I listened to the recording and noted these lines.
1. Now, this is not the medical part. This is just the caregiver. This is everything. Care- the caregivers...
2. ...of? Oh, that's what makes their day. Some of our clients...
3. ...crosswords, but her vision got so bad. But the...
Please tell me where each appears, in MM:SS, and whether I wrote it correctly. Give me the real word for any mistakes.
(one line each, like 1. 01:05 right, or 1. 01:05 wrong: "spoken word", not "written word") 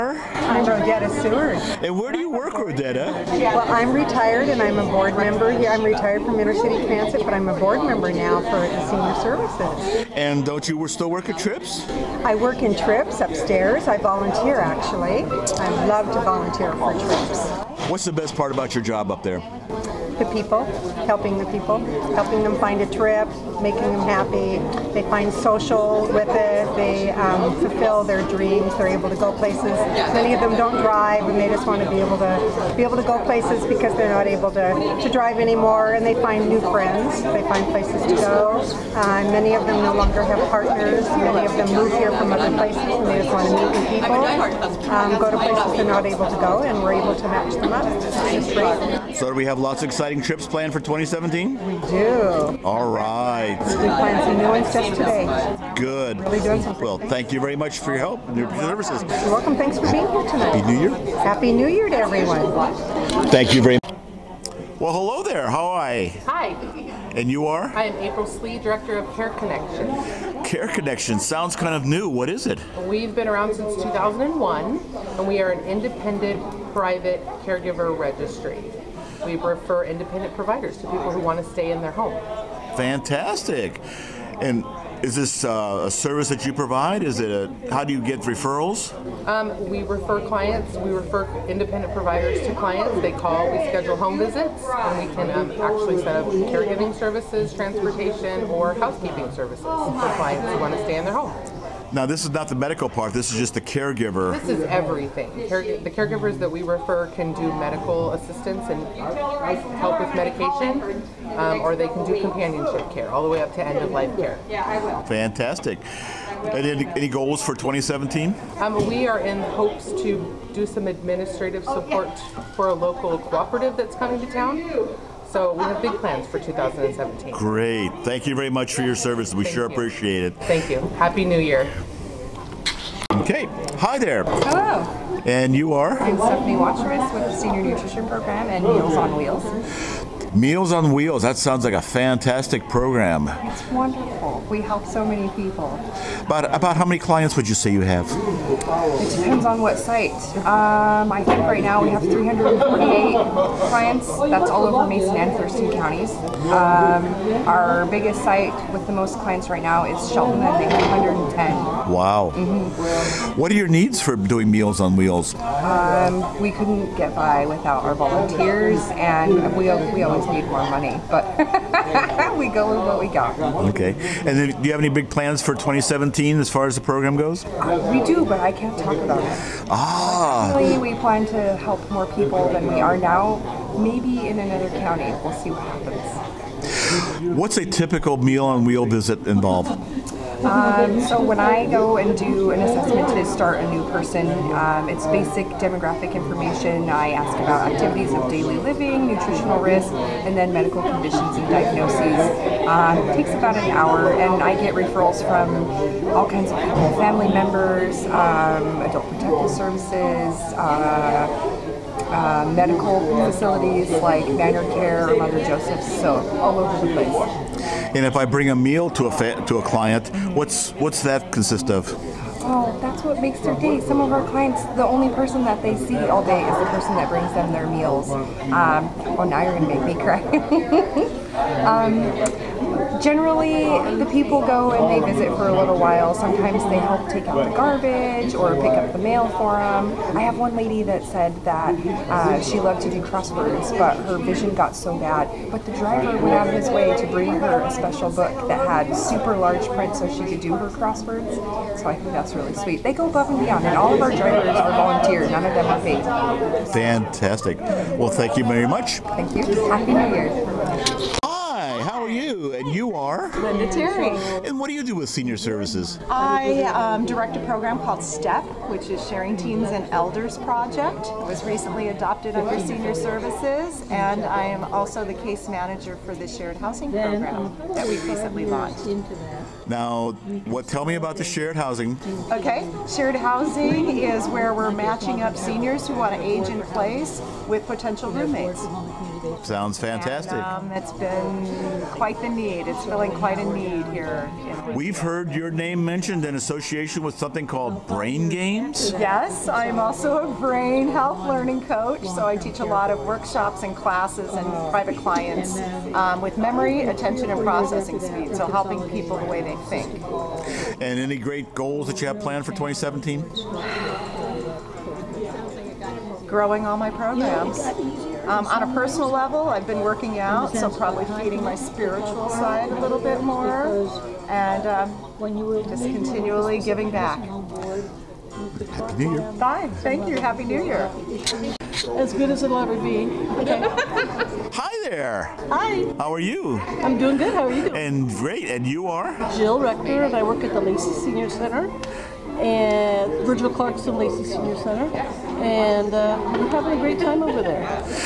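1. 01:41 right
2. 03:41 right
3. 04:03 right.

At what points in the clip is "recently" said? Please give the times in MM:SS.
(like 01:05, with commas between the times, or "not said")
04:31, 04:38.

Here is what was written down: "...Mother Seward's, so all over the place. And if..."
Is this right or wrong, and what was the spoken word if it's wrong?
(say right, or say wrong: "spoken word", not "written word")
wrong: "Joseph", not "Seward".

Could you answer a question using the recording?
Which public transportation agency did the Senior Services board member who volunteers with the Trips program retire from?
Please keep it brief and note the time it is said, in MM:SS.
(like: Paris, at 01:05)
Intercity Transit, at 00:06.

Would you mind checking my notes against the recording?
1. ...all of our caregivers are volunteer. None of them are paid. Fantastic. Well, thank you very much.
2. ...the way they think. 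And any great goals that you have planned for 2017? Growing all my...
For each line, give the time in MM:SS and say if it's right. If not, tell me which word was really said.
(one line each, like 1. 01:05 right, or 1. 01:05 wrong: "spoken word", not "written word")
1. 04:13 wrong: "drivers", not "caregivers"
2. 05:09 right.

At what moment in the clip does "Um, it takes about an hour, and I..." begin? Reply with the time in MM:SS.
03:22.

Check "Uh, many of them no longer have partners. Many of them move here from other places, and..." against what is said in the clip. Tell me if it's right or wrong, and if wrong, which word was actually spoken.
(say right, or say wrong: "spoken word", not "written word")
right.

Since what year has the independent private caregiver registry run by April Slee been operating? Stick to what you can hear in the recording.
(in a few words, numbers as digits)
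2001.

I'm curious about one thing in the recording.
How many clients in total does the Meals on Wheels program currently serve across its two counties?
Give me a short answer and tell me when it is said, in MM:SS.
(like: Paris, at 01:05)
348, at 02:32.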